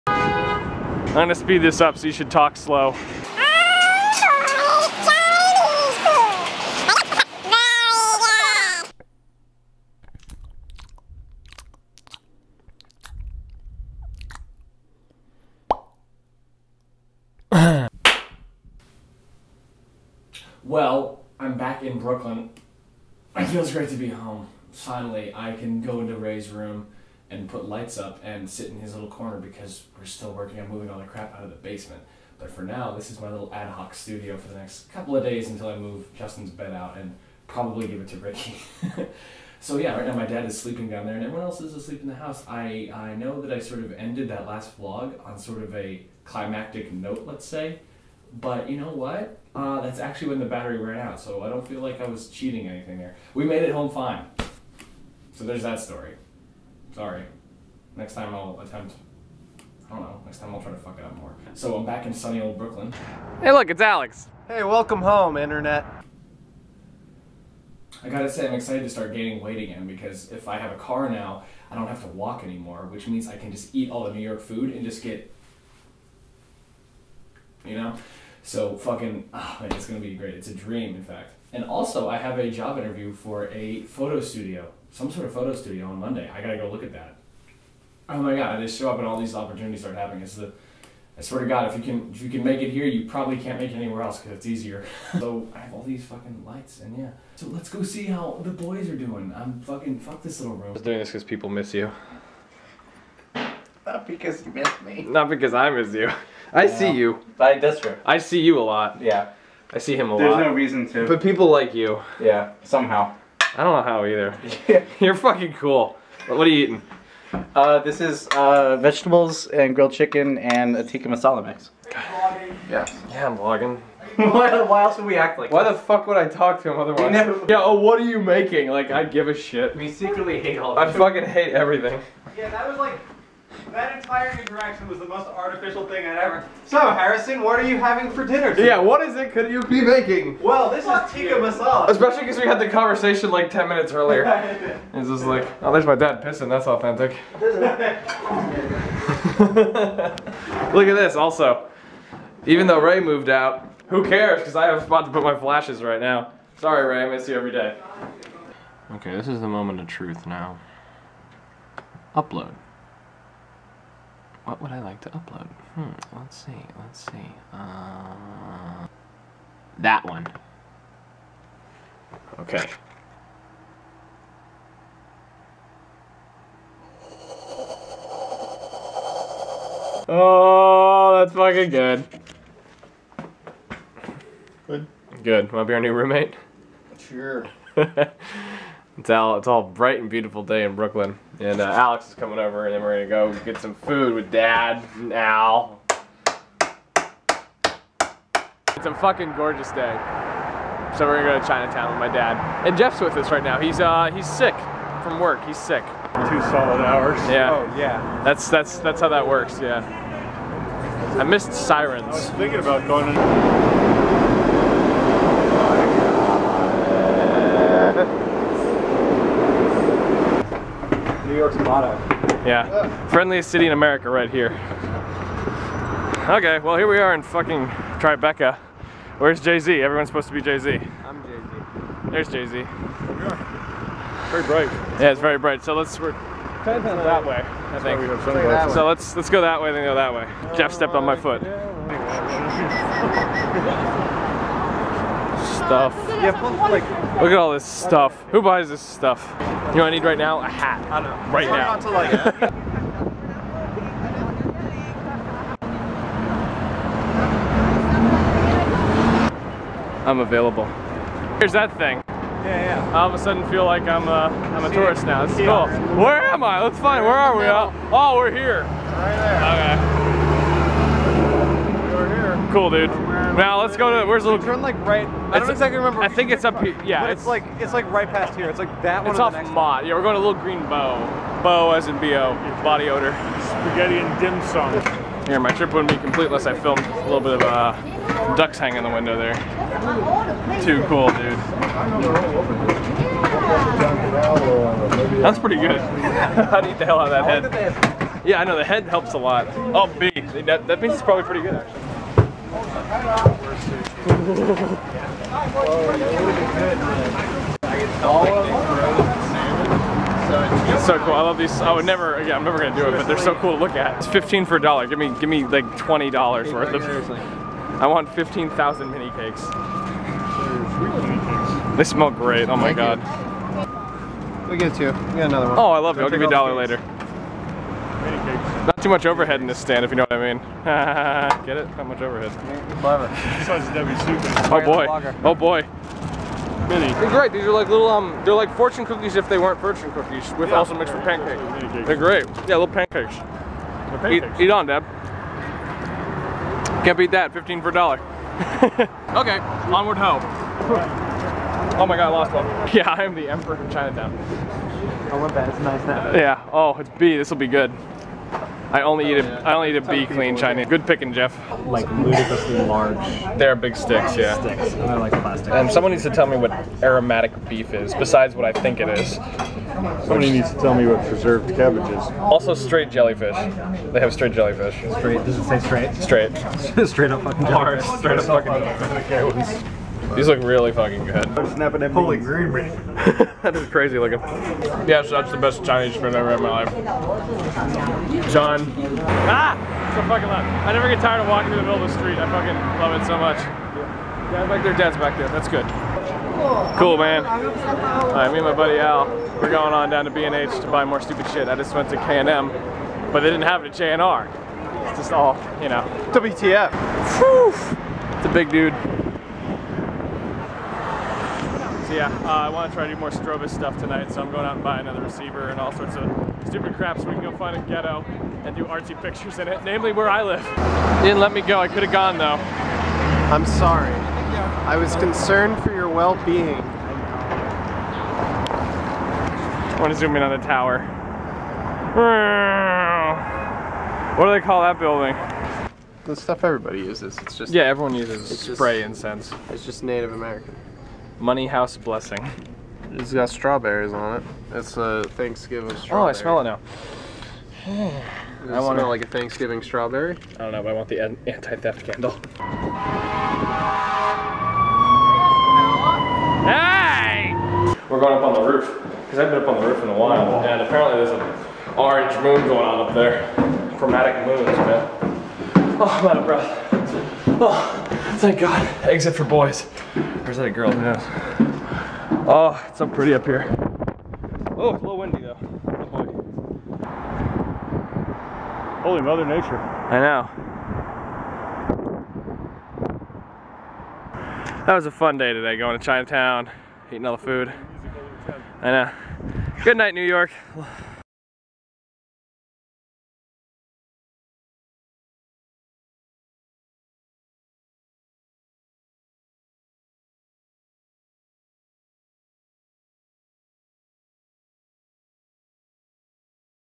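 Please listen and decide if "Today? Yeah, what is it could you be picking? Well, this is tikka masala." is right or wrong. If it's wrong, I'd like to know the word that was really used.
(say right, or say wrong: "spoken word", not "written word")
wrong: "making", not "picking".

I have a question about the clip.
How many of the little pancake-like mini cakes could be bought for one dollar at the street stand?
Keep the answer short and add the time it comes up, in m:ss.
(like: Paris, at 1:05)
15, at 5:14.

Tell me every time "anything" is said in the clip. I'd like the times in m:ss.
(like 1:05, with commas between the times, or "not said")
0:52.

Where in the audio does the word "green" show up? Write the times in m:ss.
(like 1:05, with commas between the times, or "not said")
4:40, 6:22.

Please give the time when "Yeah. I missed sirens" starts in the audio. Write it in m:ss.
3:29.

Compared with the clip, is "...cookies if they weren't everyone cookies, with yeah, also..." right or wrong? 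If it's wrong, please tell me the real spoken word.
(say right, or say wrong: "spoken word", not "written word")
wrong: "fortune", not "everyone".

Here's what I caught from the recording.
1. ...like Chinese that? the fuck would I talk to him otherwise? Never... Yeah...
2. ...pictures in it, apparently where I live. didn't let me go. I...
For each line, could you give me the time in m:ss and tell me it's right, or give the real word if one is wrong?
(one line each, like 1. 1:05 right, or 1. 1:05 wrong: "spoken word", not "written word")
1. 2:05 wrong: "Why", not "Chinese"
2. 6:59 wrong: "namely", not "apparently".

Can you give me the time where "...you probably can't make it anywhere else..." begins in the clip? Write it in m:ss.
1:32.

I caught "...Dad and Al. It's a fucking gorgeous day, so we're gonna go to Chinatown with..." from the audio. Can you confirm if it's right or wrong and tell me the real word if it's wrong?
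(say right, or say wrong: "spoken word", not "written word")
right.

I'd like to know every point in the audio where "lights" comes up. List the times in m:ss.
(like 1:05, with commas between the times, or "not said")
0:27, 1:36.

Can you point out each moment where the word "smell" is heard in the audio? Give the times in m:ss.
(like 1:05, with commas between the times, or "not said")
5:21, 7:26.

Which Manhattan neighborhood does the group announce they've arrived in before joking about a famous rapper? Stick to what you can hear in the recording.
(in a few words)
Tribeca.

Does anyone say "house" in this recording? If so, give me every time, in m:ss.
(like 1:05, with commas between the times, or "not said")
0:42, 7:21.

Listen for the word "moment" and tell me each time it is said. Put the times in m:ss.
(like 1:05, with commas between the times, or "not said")
2:39.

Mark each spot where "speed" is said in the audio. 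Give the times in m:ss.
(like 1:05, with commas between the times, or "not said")
0:01.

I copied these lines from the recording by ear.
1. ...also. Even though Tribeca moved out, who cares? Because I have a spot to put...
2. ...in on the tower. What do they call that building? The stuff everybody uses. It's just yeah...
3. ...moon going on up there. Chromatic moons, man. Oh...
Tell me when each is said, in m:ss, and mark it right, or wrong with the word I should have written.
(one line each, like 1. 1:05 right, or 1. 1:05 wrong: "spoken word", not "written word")
1. 2:31 wrong: "Ray", not "Tribeca"
2. 7:10 right
3. 7:42 right.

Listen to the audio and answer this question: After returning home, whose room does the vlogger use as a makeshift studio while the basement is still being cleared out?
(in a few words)
Ray's room.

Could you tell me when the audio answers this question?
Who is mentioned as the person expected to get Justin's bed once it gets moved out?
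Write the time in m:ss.
0:38.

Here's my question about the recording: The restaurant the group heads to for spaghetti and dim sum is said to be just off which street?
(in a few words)
Mott.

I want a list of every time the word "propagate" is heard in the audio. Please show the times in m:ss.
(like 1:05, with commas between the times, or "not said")
not said.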